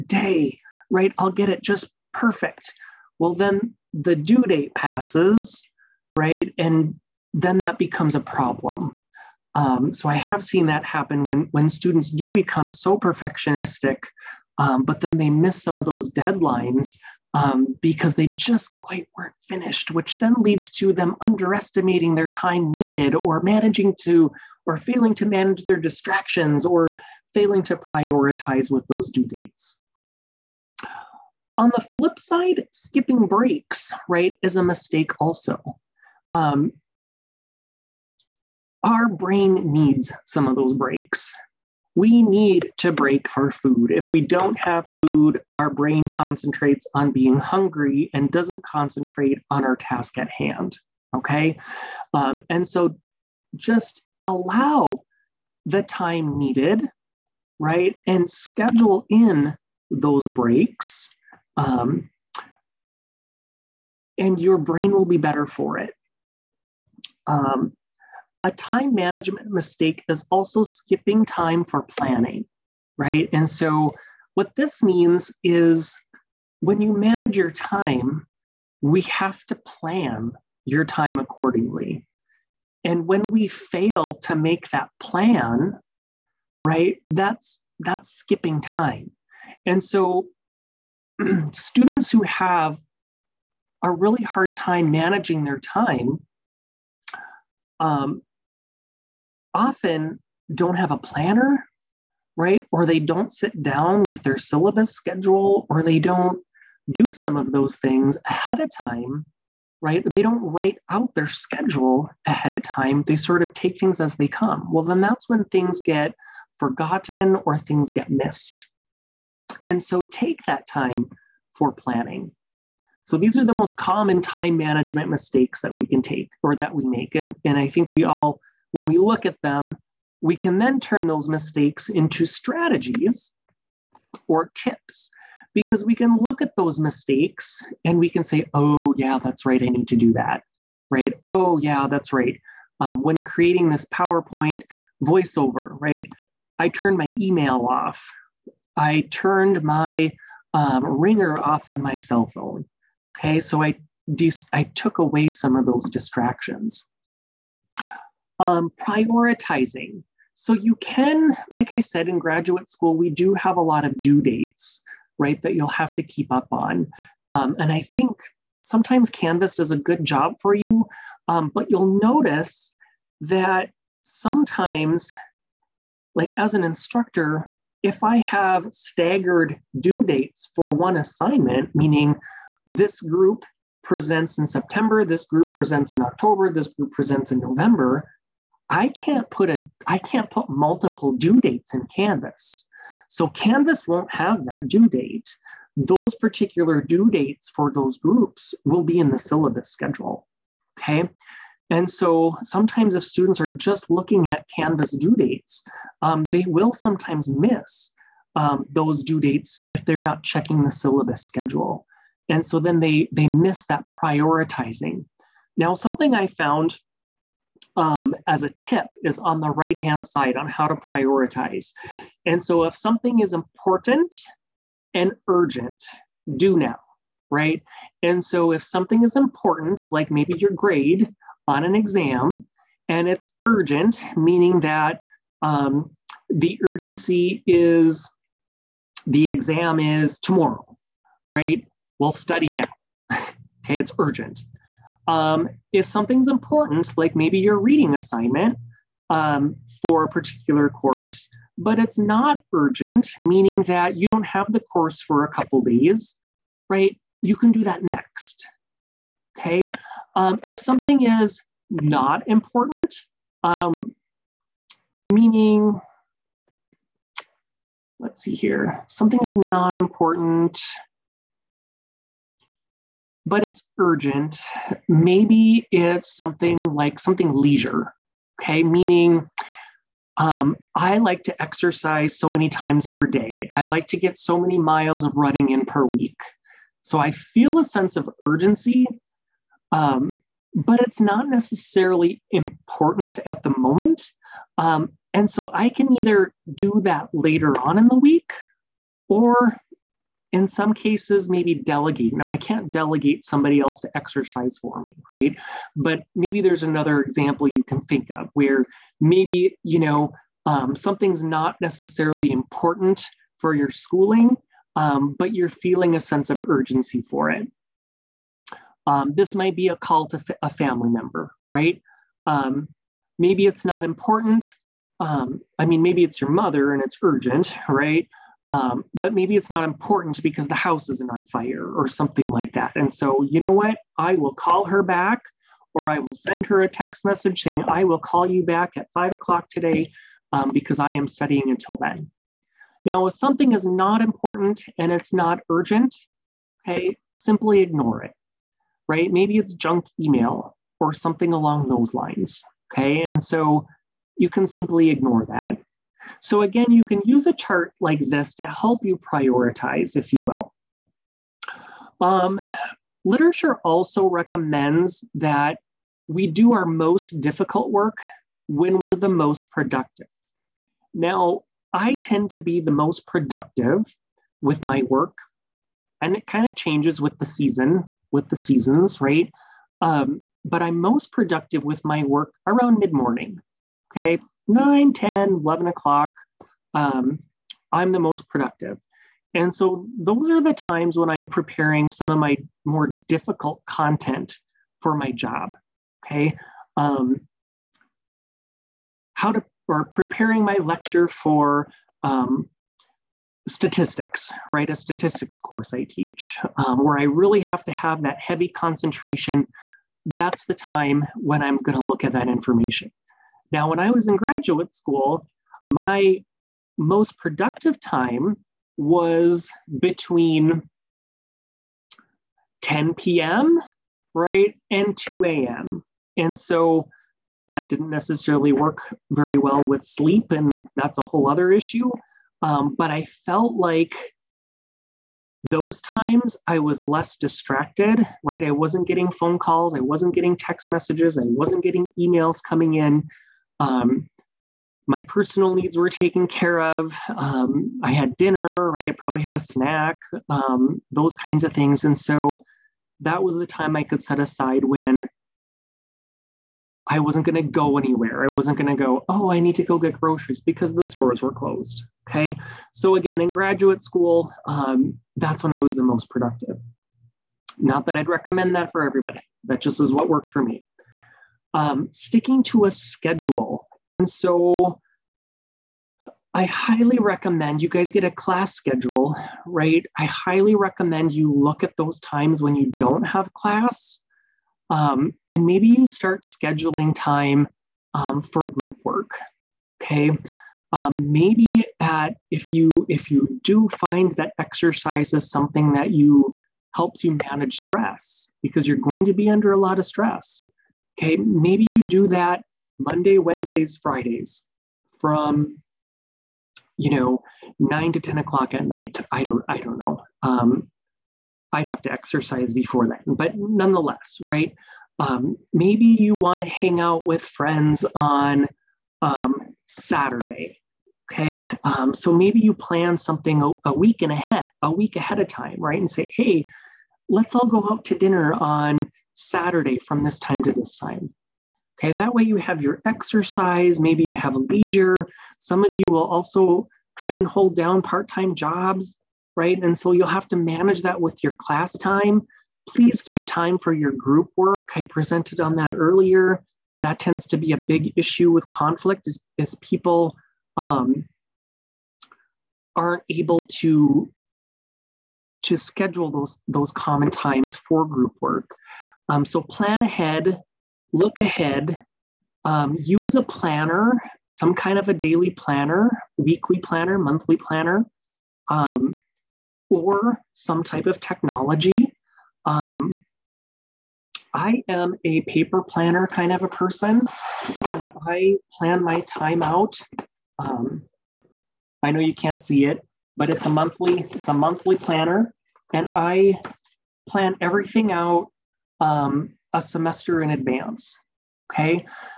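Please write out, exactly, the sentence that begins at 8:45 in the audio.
And say, hey, let's all go out to dinner on Saturday from this time to this time.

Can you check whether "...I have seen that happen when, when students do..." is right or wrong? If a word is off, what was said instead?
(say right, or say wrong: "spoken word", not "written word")
right.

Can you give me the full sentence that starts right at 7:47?
Not that I'd recommend that for everybody, that just is what worked for me um, sticking to a schedule.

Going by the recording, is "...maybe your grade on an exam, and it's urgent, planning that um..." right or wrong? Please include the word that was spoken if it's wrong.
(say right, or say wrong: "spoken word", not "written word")
wrong: "meaning", not "planning".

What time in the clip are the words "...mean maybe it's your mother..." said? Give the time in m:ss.
5:25.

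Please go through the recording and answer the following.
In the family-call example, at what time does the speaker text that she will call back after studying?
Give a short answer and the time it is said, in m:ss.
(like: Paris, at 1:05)
5 o'clock, at 5:38.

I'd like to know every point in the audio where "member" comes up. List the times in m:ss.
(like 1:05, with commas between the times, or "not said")
5:20.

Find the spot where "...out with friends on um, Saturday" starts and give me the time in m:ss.
8:36.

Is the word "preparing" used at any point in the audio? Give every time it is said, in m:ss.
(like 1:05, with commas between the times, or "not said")
6:31, 6:39.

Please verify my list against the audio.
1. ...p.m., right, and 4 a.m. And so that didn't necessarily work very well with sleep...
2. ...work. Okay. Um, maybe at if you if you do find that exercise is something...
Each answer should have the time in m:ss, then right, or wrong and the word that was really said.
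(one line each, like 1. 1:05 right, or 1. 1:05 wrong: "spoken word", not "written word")
1. 7:02 wrong: "2", not "4"
2. 8:08 right.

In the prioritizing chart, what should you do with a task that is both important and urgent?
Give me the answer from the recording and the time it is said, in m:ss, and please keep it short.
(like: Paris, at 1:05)
do now, at 3:46.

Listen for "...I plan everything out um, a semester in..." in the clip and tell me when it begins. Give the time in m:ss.
9:45.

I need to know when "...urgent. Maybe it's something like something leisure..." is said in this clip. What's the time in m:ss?
4:33.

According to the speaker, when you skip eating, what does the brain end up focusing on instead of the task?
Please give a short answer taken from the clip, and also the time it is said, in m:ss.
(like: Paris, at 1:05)
being hungry, at 0:47.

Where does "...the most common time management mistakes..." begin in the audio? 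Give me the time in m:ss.
2:03.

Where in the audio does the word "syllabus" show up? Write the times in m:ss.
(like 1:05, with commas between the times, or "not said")
1:44, 3:19, 3:30.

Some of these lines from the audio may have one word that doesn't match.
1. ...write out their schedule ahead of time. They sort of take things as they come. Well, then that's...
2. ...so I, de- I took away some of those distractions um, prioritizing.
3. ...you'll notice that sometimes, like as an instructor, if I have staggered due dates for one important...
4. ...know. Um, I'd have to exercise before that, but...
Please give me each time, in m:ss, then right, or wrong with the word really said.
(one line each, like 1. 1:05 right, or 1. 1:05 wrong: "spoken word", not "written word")
1. 1:50 right
2. 2:33 right
3. 2:51 wrong: "assignment", not "important"
4. 8:29 right.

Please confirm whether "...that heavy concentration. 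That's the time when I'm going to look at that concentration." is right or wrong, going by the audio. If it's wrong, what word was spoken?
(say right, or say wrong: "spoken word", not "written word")
wrong: "information", not "concentration".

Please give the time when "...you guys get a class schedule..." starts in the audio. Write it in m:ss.
7:57.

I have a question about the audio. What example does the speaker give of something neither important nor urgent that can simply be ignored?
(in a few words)
junk email.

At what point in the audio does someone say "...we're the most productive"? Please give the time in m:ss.
6:08.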